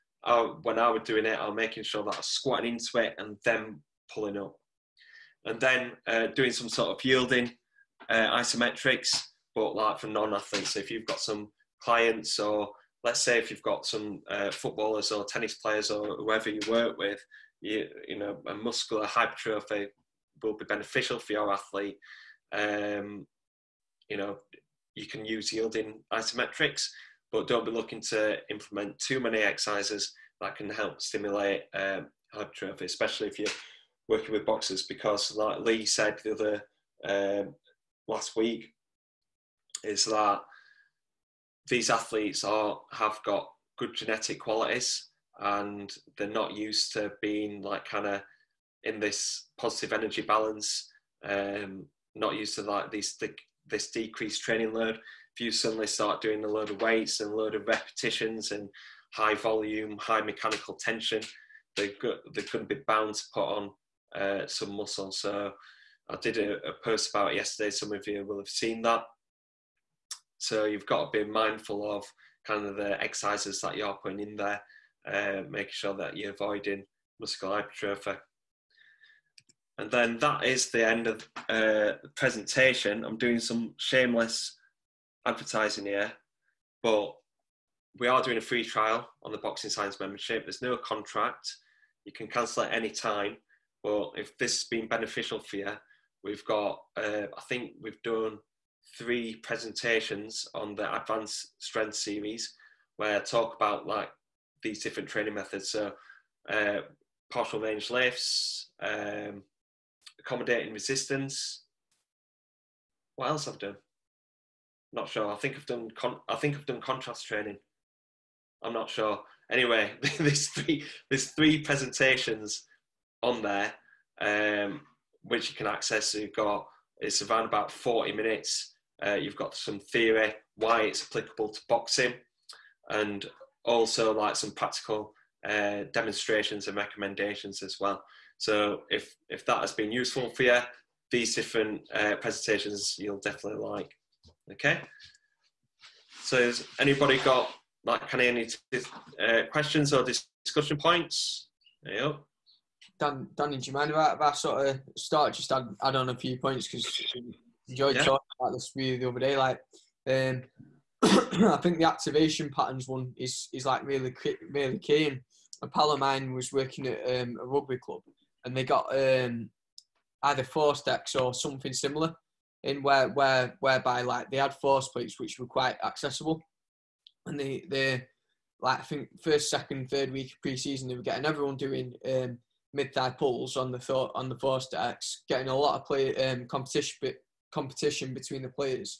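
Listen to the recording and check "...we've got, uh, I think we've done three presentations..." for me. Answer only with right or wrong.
right.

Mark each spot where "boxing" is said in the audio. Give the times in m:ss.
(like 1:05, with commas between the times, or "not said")
1:29, 2:11.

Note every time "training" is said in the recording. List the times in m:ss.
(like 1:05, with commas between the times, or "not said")
0:54, 1:45, 1:57.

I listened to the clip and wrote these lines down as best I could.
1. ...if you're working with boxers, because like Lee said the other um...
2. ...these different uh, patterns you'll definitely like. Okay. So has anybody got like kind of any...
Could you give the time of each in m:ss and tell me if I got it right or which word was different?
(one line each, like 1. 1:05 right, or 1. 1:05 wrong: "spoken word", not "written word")
1. 0:33 right
2. 2:21 wrong: "presentations", not "patterns".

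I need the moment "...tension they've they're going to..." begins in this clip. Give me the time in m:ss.
1:00.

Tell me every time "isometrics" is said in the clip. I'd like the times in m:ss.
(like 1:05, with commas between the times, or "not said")
0:08, 0:26.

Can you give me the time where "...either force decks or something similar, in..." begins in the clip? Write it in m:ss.
2:50.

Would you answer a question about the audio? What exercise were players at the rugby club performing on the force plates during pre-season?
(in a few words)
mid-thigh pulls.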